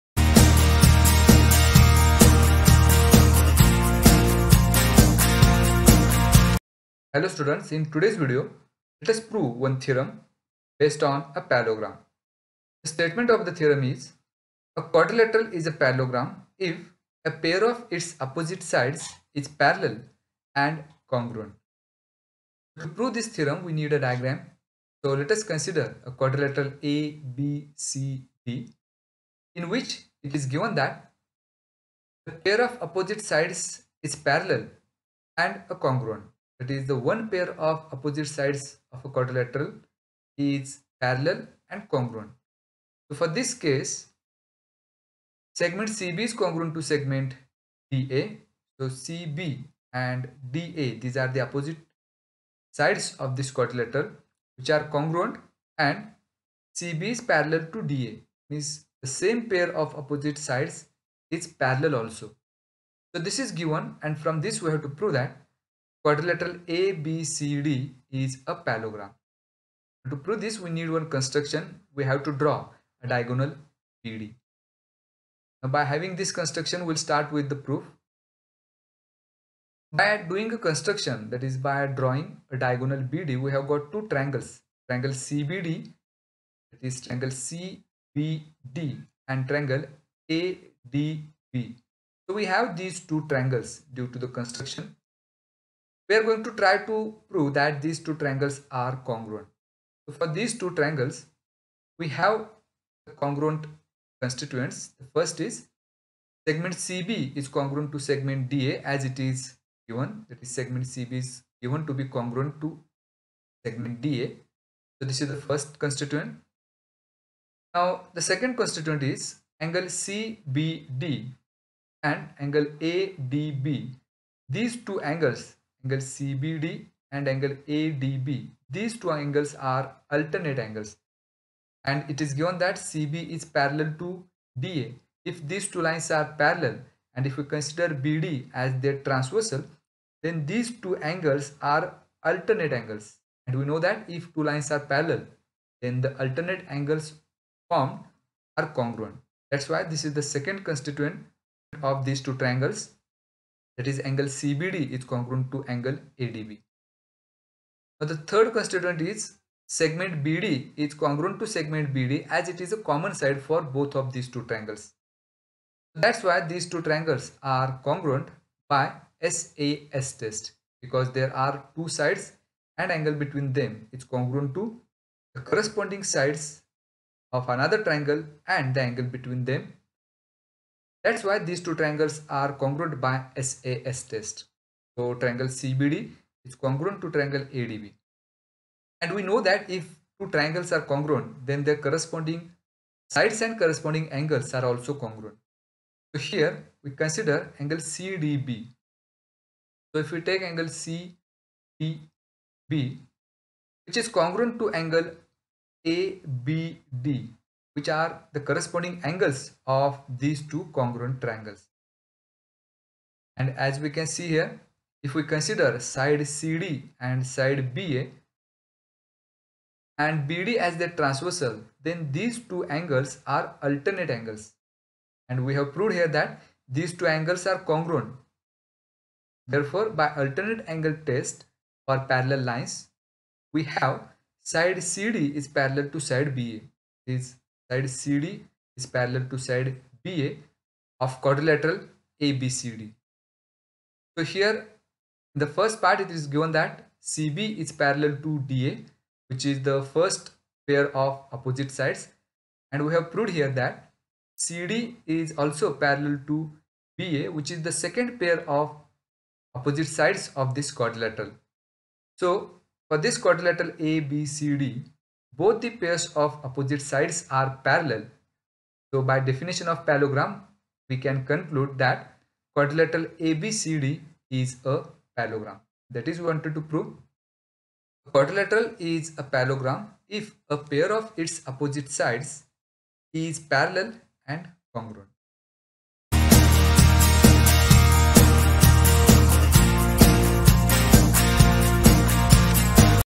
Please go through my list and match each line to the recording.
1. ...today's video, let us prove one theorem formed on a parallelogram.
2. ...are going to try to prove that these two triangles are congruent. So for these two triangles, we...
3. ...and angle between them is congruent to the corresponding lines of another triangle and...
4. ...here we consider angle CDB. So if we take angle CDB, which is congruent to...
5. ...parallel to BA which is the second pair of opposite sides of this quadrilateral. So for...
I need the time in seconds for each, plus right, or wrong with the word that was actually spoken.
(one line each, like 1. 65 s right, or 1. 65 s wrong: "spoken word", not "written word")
1. 7 s wrong: "based", not "formed"
2. 96 s right
3. 172 s wrong: "sides", not "lines"
4. 196 s right
5. 255 s right.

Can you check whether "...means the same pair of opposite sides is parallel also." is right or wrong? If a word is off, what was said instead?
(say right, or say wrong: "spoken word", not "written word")
right.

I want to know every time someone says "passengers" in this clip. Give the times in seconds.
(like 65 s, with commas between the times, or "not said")
not said.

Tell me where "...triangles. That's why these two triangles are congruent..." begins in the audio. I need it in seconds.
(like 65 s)
164 s.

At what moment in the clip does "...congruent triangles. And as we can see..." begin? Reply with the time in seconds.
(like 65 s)
210 s.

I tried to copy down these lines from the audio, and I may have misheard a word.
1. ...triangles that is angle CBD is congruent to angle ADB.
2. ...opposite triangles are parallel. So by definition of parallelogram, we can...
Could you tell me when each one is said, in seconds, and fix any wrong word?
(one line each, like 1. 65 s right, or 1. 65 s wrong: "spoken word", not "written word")
1. 152 s right
2. 266 s wrong: "sides", not "triangles".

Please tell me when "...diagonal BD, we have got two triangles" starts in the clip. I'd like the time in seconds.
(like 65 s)
82 s.